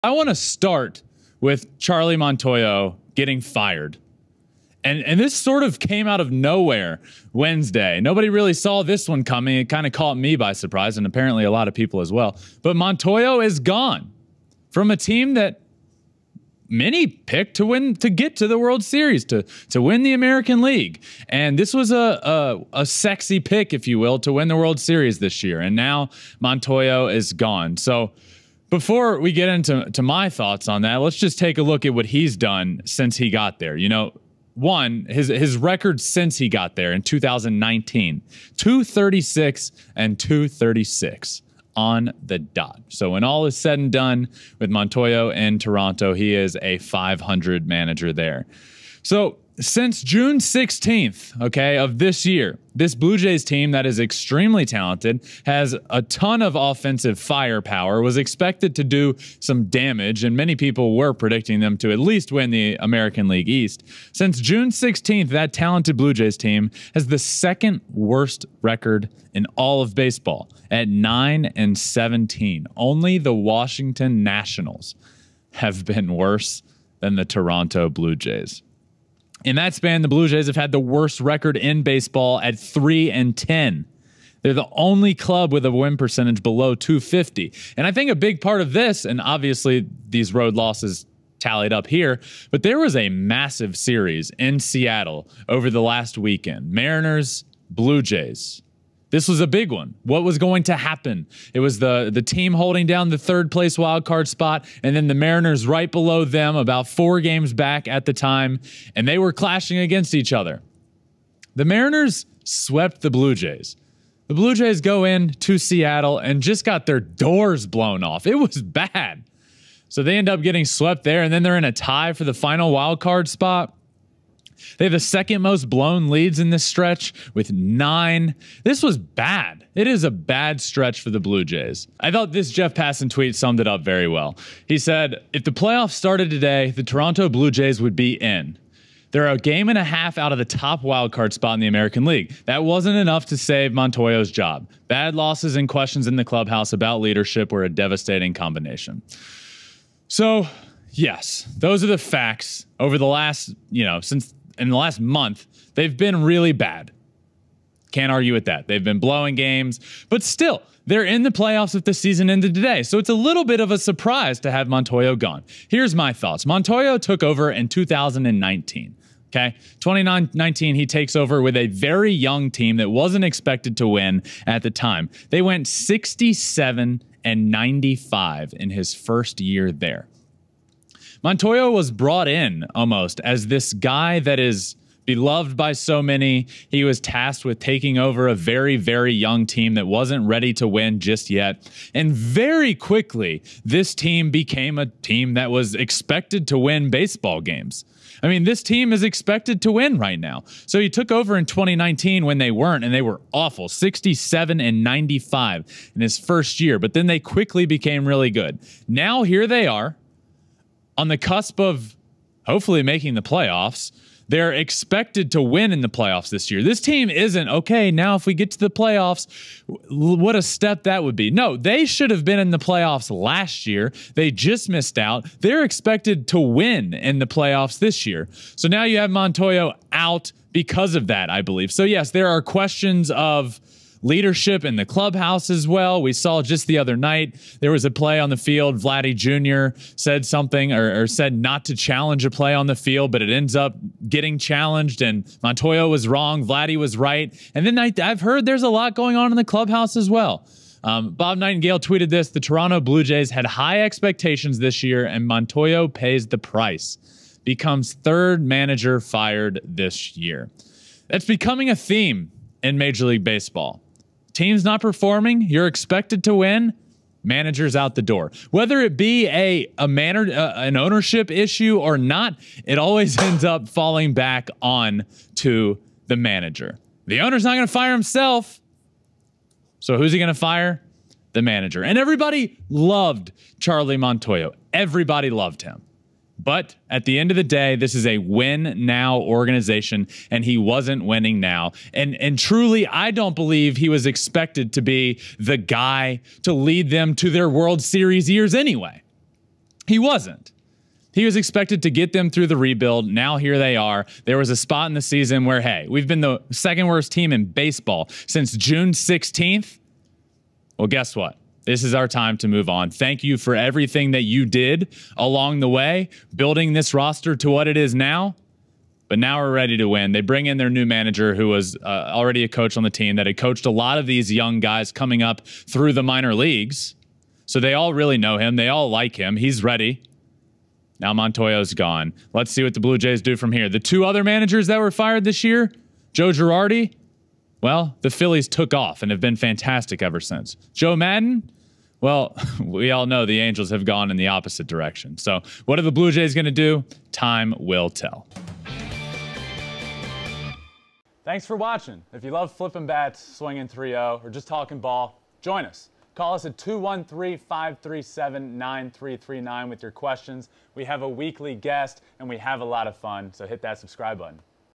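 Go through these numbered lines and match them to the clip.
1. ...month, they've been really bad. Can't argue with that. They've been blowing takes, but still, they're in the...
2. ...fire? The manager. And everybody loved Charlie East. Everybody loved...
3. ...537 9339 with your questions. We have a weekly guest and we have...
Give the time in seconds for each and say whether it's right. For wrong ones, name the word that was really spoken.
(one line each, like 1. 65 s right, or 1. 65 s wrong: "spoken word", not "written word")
1. 155 s wrong: "games", not "takes"
2. 280 s wrong: "Montoyo", not "East"
3. 357 s right.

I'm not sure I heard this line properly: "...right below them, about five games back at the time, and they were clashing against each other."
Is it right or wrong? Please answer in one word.
wrong.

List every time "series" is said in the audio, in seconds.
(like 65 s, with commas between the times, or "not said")
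18 s, 24 s, 93 s, 297 s.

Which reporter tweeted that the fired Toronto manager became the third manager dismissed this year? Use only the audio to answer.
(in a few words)
Bob Nightingale.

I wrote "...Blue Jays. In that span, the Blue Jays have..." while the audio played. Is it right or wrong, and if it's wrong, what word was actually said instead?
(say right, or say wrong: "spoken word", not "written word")
right.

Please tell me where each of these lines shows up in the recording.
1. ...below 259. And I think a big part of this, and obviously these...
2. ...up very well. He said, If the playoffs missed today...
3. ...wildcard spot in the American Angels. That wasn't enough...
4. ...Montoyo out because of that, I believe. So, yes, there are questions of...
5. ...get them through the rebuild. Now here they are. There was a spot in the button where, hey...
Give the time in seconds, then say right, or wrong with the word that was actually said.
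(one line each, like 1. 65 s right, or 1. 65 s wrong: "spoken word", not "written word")
1. 86 s wrong: "250", not "259"
2. 133 s wrong: "started", not "missed"
3. 140 s wrong: "League", not "Angels"
4. 229 s right
5. 301 s wrong: "season", not "button".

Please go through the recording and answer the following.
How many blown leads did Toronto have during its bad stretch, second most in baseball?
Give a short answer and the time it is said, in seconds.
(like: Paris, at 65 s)
9, at 127 s.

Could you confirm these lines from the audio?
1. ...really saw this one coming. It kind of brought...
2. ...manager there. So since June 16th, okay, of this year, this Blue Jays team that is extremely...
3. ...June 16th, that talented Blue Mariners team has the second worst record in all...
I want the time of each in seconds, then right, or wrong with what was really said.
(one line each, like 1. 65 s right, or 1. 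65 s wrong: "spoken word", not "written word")
1. 8 s wrong: "caught", not "brought"
2. 47 s right
3. 64 s wrong: "Jays", not "Mariners".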